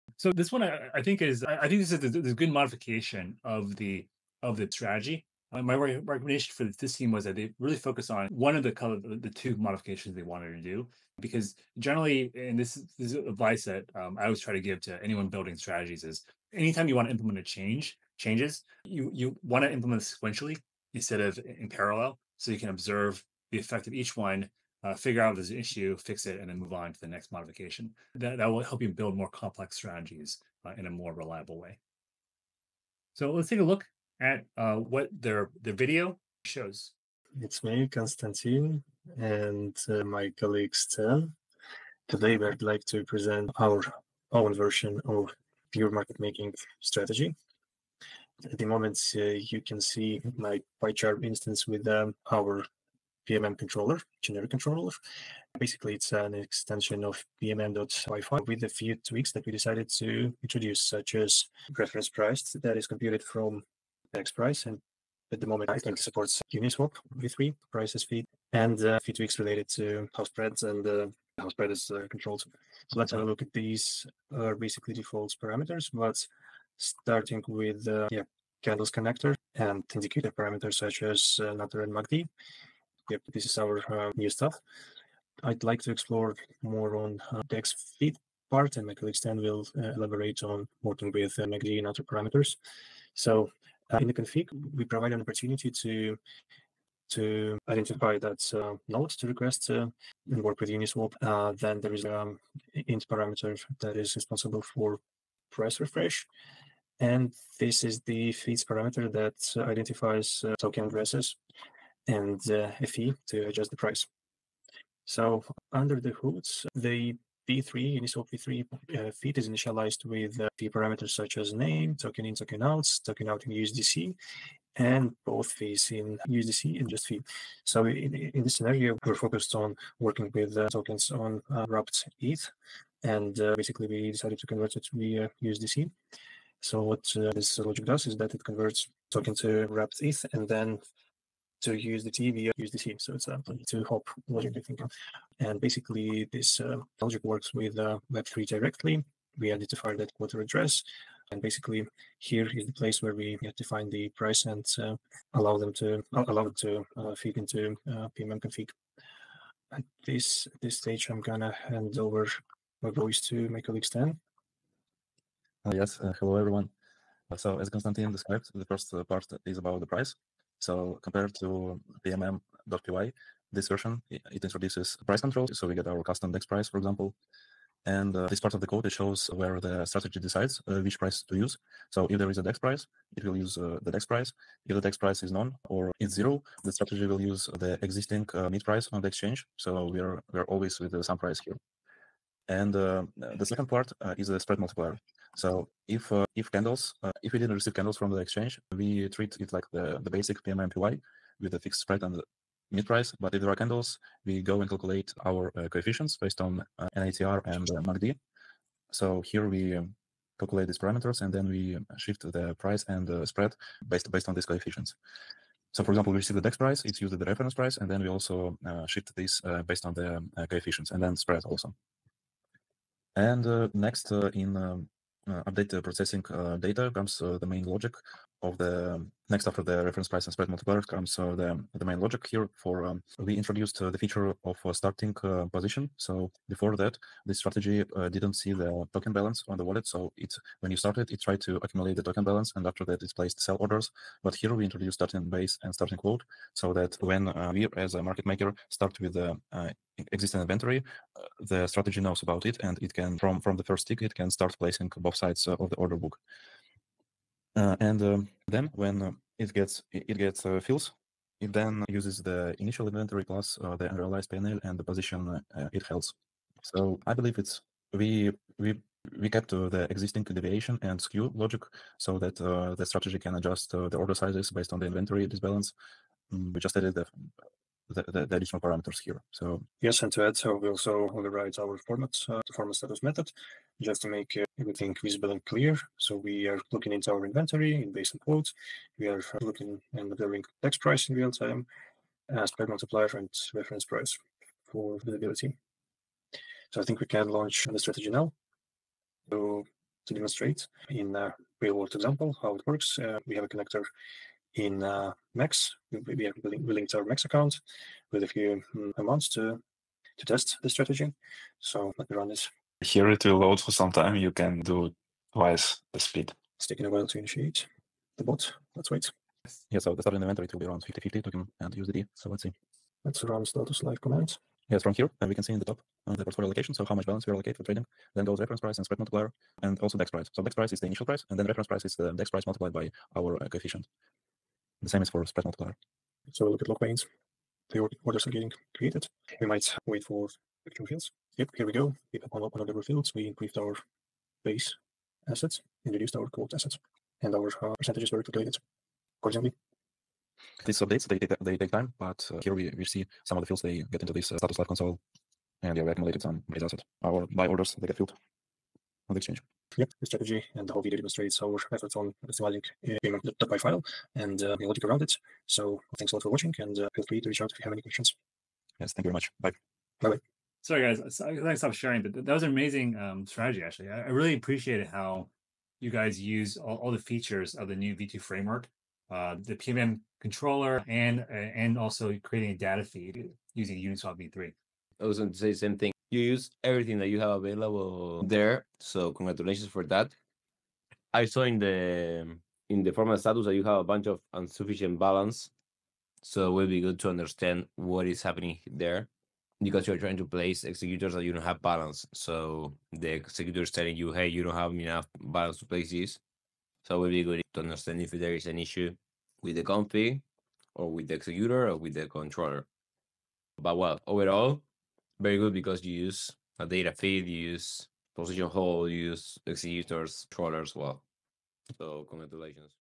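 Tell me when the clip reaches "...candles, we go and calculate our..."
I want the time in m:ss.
3:23.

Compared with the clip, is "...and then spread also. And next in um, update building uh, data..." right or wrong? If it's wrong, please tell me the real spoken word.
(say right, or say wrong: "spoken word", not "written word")
wrong: "processing", not "building".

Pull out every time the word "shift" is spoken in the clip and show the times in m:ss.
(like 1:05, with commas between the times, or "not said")
3:31, 3:38.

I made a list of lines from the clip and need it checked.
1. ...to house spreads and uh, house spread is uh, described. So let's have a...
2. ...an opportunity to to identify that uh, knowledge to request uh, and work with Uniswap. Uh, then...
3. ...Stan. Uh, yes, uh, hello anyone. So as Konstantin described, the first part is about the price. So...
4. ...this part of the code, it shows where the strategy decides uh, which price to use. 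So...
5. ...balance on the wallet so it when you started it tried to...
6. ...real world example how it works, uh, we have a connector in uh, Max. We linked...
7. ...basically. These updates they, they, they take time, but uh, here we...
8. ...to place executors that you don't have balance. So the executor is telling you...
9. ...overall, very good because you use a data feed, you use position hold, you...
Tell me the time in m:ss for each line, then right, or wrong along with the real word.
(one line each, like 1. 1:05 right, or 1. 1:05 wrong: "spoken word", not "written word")
1. 1:09 wrong: "controlled", not "described"
2. 1:35 right
3. 2:43 wrong: "everyone", not "anyone"
4. 2:58 right
5. 3:59 right
6. 5:01 right
7. 5:49 wrong: "accordingly", not "basically"
8. 6:40 right
9. 6:54 right.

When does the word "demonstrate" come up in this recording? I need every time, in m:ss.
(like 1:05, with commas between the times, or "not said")
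5:00, 6:00.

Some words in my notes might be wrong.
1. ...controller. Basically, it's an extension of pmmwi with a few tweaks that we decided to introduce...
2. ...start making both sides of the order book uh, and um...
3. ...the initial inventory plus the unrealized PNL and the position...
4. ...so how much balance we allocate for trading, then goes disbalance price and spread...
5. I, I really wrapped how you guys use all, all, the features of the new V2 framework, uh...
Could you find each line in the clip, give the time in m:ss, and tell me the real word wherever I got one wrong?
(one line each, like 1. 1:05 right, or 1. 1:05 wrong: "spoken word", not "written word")
1. 0:54 right
2. 4:14 wrong: "placing", not "making"
3. 4:22 right
4. 5:26 wrong: "reference", not "disbalance"
5. 6:13 wrong: "appreciated", not "wrapped".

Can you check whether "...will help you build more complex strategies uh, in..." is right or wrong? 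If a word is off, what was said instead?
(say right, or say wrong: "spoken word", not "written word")
right.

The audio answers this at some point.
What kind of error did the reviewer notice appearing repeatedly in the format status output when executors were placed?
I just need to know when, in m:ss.
6:34.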